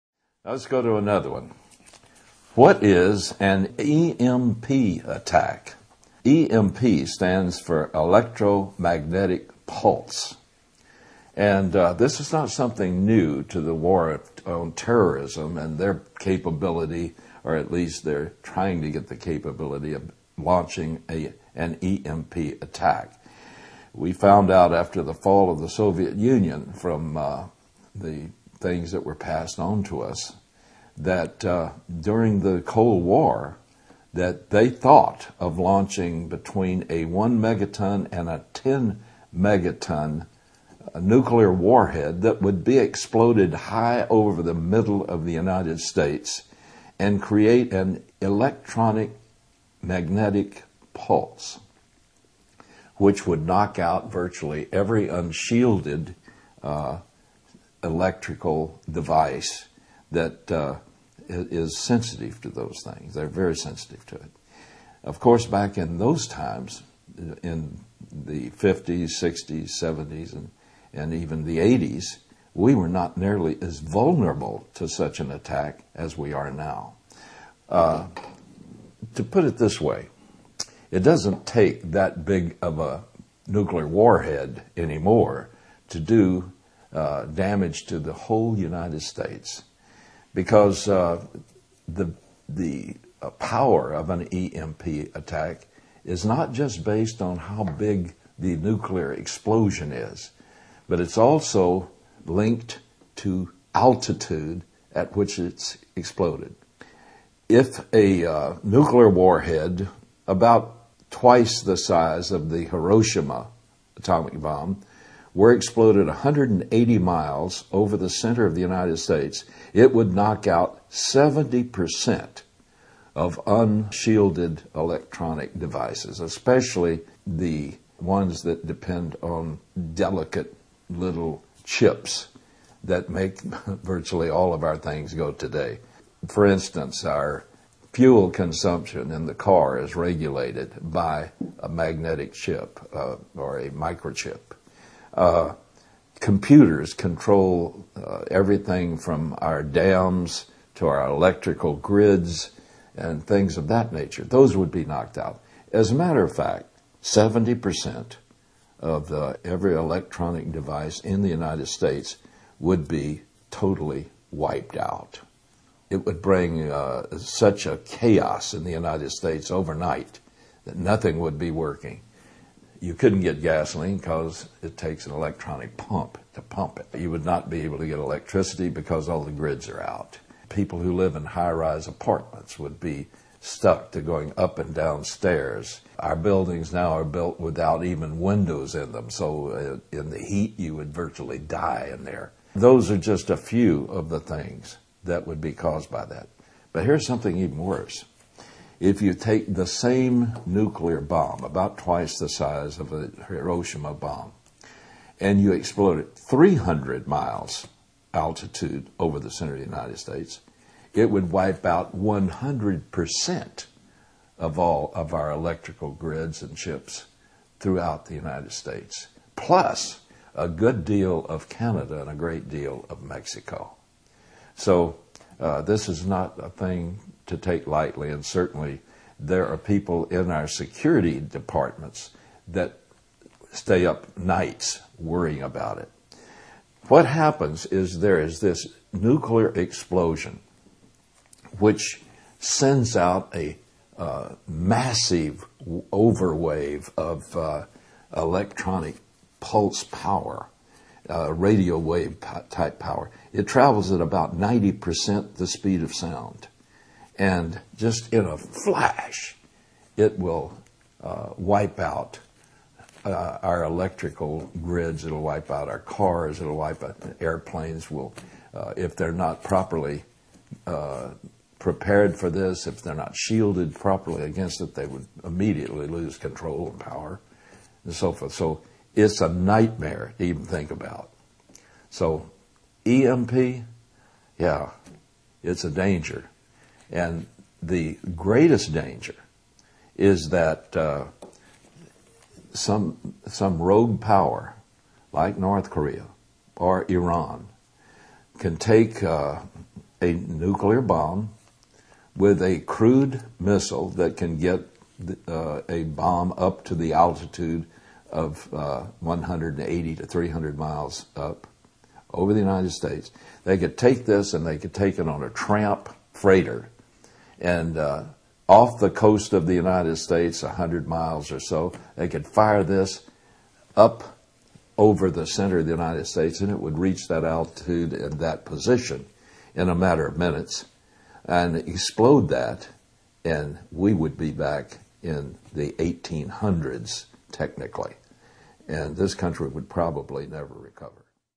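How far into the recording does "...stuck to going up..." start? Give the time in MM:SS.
03:03.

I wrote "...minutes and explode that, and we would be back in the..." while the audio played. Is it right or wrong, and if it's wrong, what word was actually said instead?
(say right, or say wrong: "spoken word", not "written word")
right.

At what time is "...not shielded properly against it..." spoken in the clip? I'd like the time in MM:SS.
04:32.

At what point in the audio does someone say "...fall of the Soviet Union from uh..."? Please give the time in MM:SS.
00:25.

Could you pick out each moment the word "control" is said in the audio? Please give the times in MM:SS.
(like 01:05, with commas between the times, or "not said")
02:26, 04:36.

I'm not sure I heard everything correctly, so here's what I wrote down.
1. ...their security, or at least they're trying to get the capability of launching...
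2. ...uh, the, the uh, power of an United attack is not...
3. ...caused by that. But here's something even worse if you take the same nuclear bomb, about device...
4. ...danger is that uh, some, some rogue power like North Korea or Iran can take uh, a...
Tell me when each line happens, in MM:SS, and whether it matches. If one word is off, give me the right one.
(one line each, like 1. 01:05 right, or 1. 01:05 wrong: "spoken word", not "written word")
1. 00:15 wrong: "capability", not "security"
2. 01:30 wrong: "EMP", not "United"
3. 03:15 wrong: "twice", not "device"
4. 04:48 right.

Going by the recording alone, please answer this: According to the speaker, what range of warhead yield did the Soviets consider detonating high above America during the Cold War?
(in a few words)
1 to 10 megaton.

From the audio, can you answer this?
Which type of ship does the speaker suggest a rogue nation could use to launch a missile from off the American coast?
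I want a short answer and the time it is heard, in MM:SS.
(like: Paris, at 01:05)
tramp freighter, at 05:15.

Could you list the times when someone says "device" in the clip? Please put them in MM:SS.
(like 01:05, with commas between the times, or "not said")
00:58, 02:05, 02:40.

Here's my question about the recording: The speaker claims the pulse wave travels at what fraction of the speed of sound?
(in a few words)
90%.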